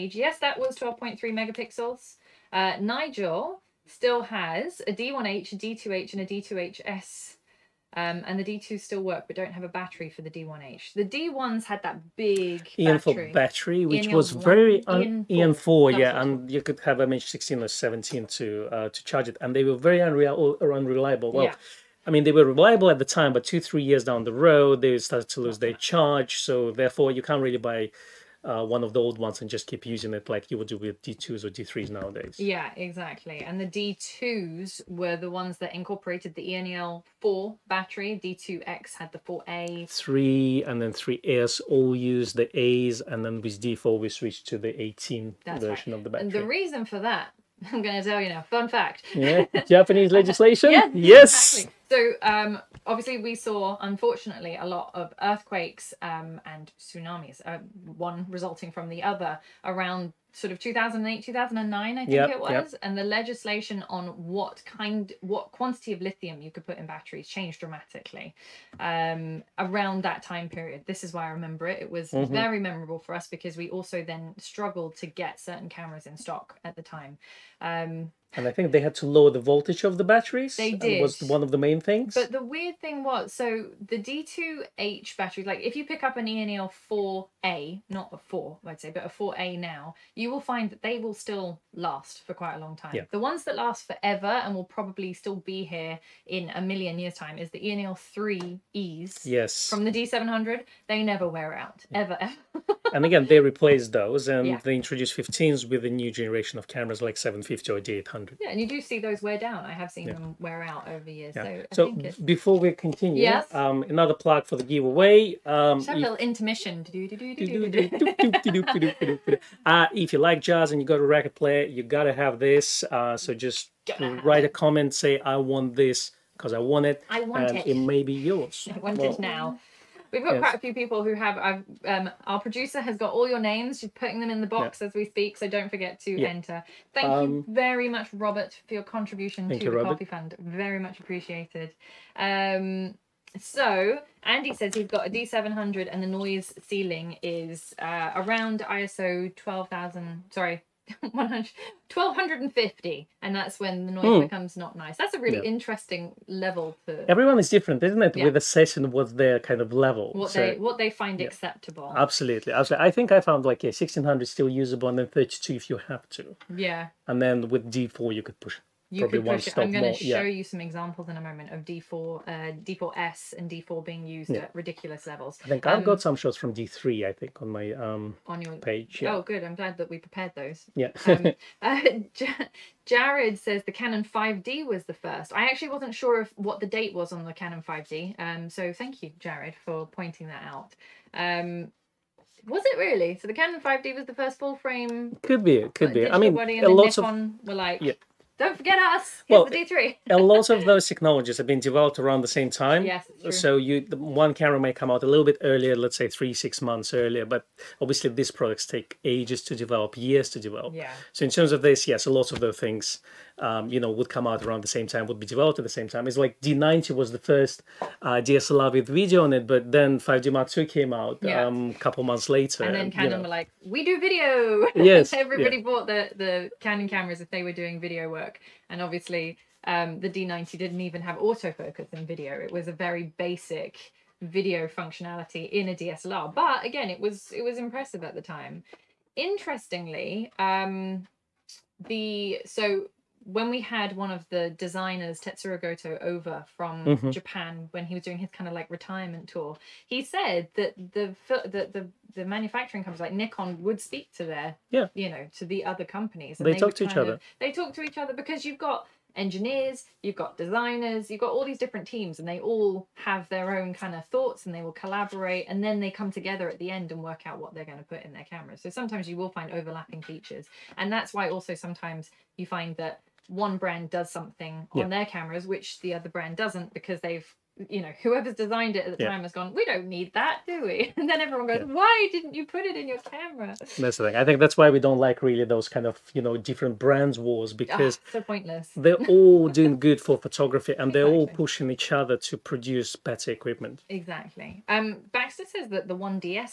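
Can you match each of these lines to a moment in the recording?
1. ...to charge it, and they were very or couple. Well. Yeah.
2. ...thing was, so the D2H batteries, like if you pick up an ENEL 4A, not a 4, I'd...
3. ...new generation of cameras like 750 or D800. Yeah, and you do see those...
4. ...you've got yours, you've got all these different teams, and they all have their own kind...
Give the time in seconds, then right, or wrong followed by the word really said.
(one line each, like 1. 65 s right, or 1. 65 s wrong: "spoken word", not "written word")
1. 18 s wrong: "unreliable", not "couple"
2. 82 s right
3. 105 s right
4. 260 s wrong: "designers", not "yours".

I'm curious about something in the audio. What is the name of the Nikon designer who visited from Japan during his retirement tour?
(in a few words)
Tetsuro Goto.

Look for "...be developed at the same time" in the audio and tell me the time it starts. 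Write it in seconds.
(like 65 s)
215 s.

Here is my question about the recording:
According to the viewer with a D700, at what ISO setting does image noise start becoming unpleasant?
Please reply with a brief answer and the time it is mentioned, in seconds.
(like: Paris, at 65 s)
1250, at 151 s.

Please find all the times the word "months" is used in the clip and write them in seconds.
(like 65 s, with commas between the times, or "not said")
206 s, 222 s.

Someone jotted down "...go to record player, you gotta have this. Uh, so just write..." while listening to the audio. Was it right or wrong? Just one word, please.
right.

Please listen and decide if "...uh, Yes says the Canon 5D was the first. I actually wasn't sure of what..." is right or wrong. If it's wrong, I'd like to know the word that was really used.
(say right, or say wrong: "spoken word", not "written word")
wrong: "Jared", not "Yes".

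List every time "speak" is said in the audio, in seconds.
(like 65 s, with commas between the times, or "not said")
135 s, 253 s.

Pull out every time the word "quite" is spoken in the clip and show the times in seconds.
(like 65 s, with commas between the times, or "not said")
92 s, 130 s.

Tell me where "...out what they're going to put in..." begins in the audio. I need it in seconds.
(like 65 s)
267 s.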